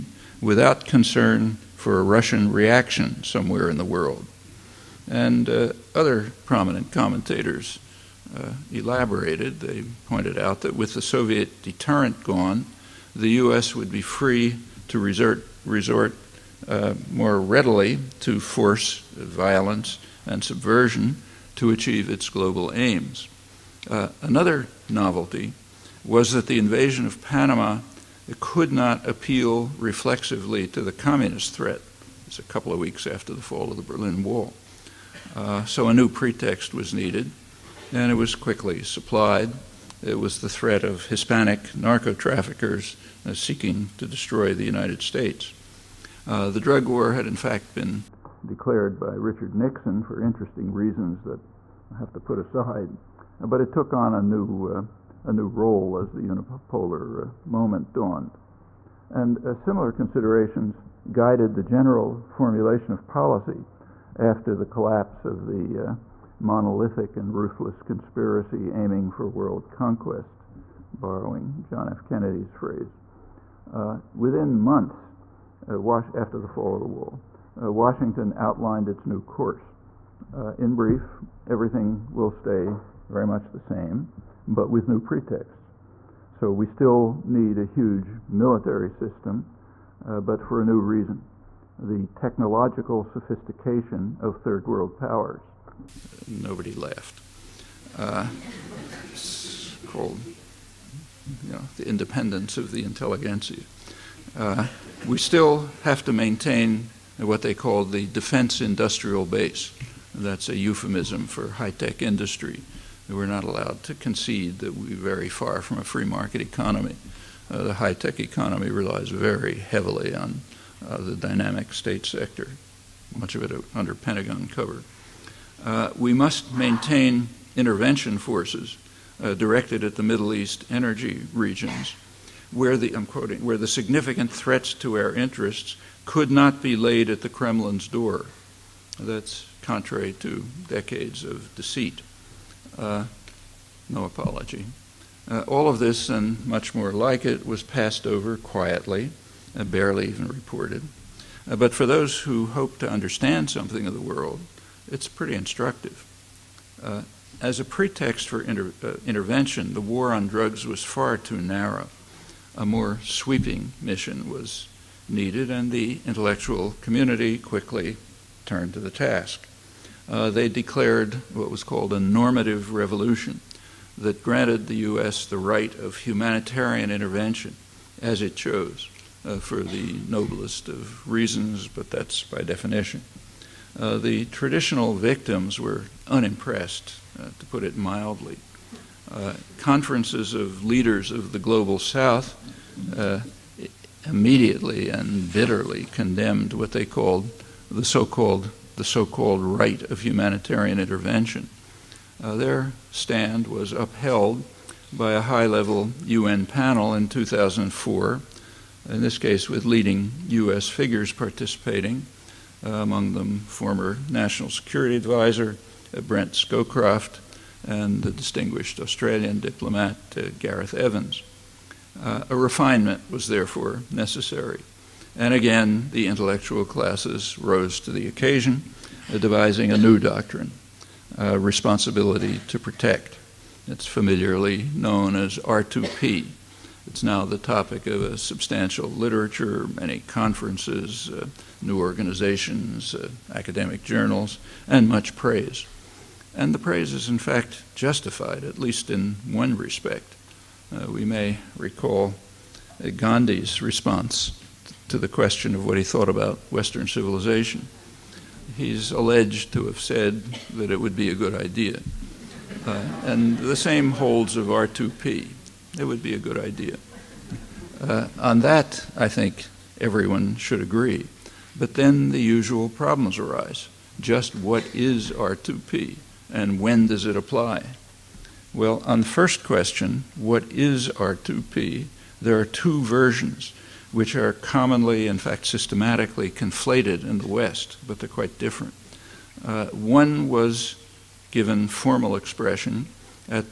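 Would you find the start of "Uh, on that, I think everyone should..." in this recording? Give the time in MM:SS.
04:27.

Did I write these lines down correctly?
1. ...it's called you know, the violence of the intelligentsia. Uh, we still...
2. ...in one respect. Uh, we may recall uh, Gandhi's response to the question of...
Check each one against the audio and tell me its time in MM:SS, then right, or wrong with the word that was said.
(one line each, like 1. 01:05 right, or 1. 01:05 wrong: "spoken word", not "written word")
1. 01:39 wrong: "independence", not "violence"
2. 04:08 right.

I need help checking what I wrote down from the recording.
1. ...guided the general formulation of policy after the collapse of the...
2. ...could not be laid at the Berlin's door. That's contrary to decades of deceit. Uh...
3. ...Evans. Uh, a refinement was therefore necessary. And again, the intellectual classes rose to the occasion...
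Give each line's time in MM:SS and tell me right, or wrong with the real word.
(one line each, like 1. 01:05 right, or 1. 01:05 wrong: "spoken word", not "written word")
1. 01:01 right
2. 02:16 wrong: "Kremlin", not "Berlin"
3. 03:40 right.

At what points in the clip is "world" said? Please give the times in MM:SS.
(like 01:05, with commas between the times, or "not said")
00:03, 01:09, 01:34, 02:33.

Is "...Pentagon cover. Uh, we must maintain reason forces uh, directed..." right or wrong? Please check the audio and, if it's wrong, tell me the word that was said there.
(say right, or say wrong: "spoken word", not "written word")
wrong: "intervention", not "reason".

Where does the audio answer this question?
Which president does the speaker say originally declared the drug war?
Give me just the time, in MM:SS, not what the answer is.
00:49.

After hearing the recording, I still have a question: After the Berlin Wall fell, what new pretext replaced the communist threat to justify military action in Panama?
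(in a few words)
Hispanic narco traffickers.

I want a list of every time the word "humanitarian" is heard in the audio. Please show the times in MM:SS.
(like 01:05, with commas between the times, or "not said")
02:55, 03:20.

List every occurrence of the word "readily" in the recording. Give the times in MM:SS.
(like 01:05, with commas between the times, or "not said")
00:17.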